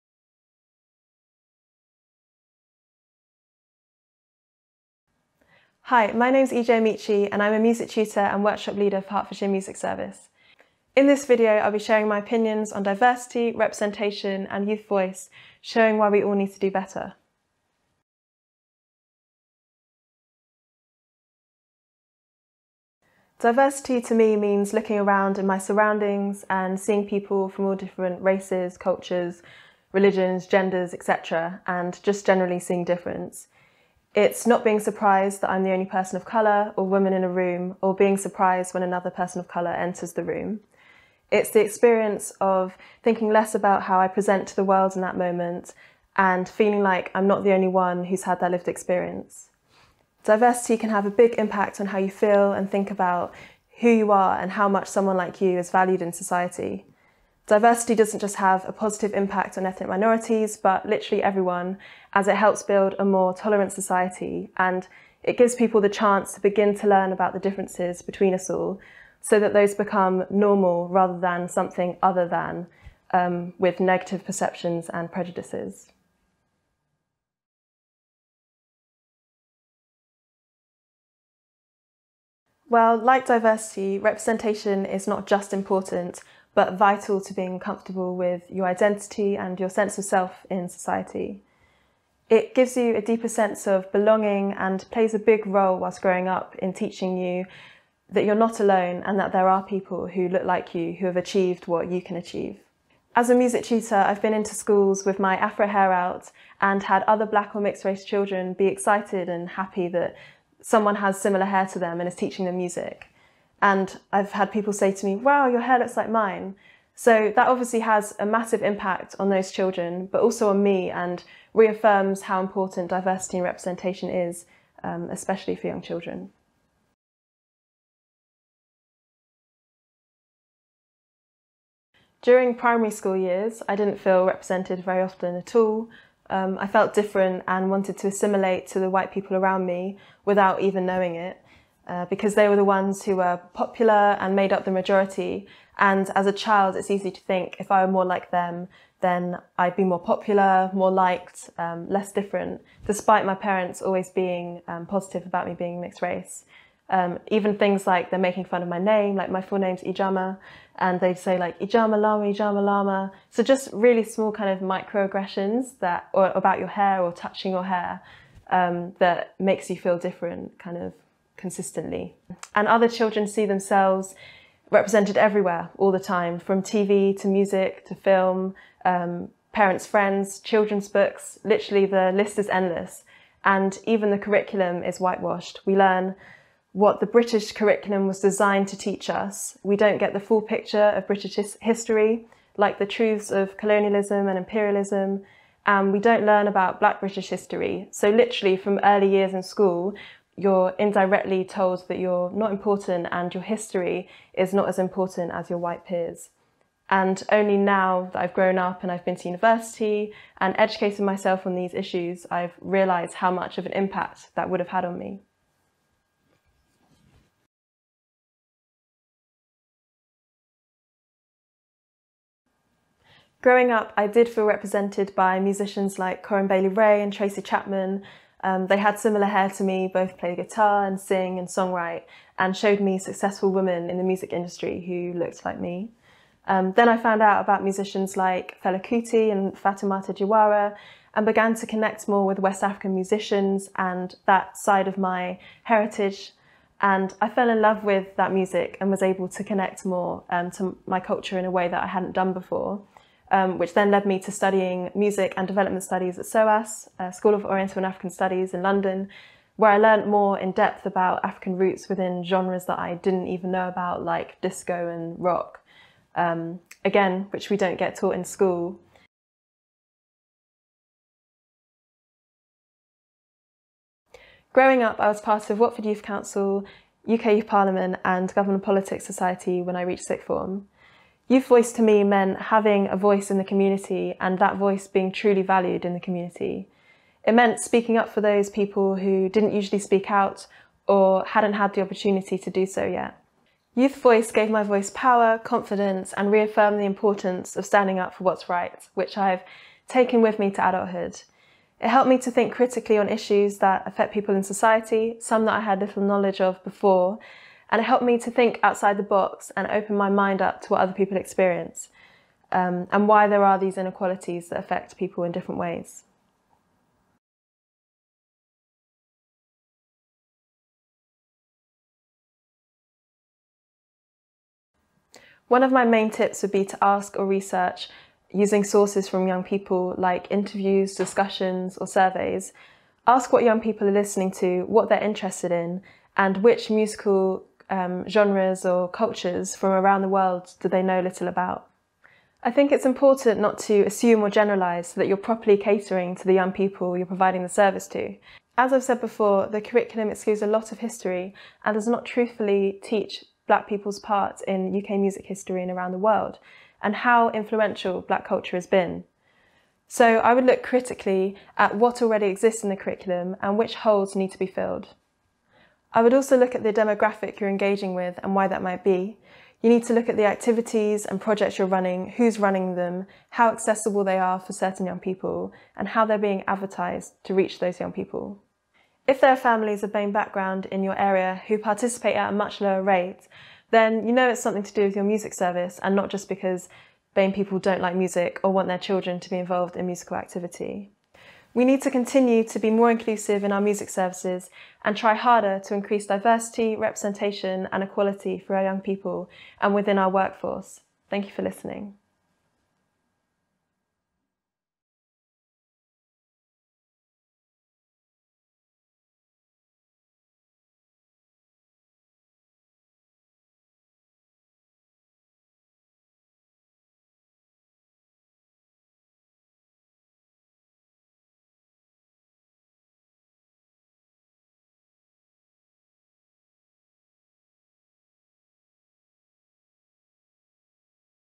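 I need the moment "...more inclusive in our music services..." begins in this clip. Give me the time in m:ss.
6:32.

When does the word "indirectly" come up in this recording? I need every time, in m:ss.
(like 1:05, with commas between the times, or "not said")
3:20.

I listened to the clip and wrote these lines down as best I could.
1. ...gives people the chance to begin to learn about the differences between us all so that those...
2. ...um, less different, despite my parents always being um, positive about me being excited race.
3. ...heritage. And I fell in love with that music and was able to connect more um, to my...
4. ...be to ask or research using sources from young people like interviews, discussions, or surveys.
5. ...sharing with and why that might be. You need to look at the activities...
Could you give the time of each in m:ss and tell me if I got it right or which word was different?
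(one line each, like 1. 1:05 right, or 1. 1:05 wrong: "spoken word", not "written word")
1. 1:05 right
2. 2:31 wrong: "mixed", not "excited"
3. 4:05 right
4. 5:26 right
5. 6:07 wrong: "engaging", not "sharing".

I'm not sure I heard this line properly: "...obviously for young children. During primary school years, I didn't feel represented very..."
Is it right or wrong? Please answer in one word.
wrong.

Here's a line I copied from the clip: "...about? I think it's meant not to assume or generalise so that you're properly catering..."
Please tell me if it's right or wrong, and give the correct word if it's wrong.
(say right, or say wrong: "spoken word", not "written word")
wrong: "important", not "meant".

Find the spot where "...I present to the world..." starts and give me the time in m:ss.
0:44.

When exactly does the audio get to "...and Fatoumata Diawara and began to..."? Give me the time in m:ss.
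3:59.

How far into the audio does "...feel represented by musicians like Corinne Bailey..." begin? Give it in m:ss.
3:44.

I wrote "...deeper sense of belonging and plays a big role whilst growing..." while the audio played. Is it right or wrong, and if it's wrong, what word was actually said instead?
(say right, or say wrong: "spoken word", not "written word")
right.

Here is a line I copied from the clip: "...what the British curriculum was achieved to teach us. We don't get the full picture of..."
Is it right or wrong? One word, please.
wrong.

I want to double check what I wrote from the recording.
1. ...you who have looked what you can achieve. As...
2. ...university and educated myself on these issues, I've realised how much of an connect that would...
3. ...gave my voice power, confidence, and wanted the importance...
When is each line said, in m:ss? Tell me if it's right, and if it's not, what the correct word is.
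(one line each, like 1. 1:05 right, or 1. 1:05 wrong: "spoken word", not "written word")
1. 1:40 wrong: "achieved", not "looked"
2. 3:29 wrong: "impact", not "connect"
3. 4:54 wrong: "reaffirmed", not "wanted".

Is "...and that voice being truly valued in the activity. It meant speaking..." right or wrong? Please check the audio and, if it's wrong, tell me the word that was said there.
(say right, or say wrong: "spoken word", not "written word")
wrong: "community", not "activity".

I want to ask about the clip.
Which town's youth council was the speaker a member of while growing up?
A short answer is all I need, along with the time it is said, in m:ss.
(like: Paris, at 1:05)
Watford, at 4:35.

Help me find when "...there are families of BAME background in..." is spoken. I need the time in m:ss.
6:19.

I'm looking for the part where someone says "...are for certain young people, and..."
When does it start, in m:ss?
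6:14.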